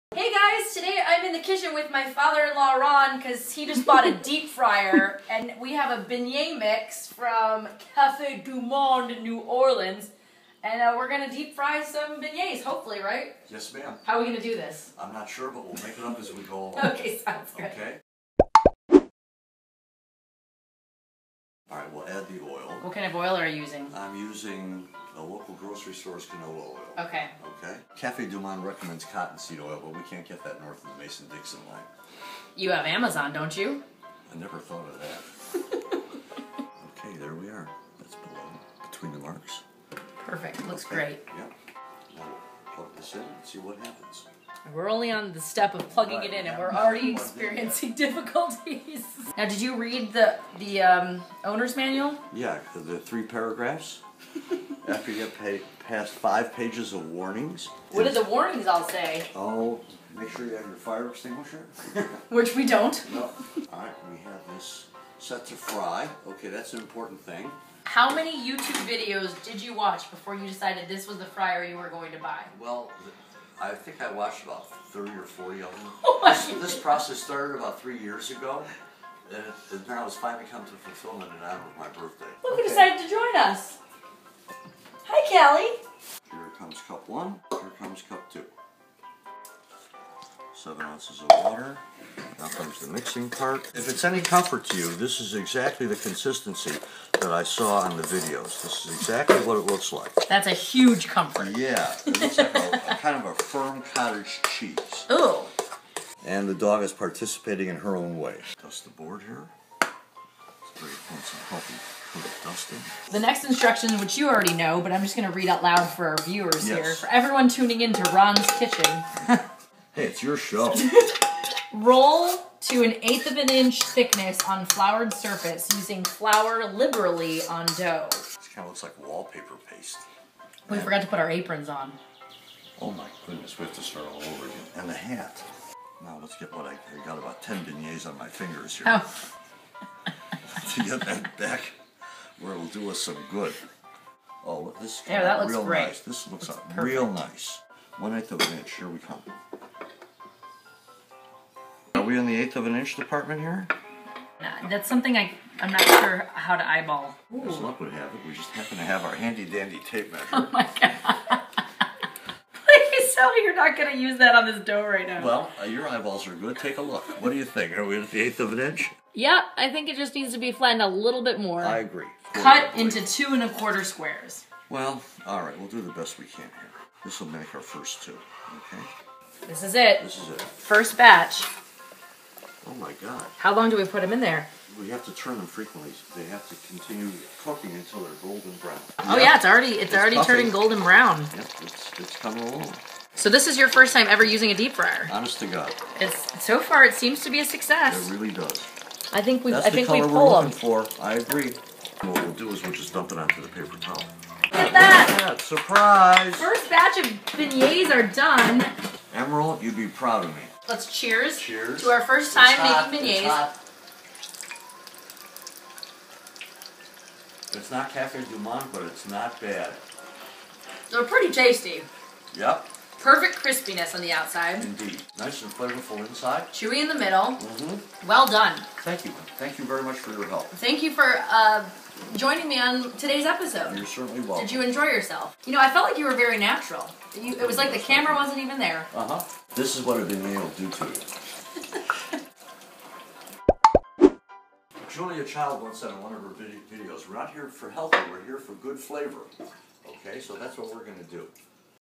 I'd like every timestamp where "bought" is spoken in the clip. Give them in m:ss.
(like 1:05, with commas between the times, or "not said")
0:03.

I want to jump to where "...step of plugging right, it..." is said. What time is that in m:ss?
0:45.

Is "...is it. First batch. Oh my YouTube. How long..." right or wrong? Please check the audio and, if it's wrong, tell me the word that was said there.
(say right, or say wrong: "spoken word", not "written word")
wrong: "God", not "YouTube".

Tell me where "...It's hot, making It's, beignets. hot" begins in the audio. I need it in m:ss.
3:32.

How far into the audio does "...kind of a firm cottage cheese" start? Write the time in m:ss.
1:42.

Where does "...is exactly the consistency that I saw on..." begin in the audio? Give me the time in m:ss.
1:35.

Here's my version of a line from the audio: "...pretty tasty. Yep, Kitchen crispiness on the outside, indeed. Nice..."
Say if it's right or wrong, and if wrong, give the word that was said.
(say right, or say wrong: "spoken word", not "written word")
wrong: "Perfect", not "Kitchen".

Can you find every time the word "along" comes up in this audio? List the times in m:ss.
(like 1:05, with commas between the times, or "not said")
0:16, 3:12.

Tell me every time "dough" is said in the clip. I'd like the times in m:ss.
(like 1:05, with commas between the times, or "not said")
2:07, 2:44.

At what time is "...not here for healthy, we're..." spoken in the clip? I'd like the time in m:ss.
4:07.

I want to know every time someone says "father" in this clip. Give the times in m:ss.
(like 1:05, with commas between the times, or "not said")
0:02.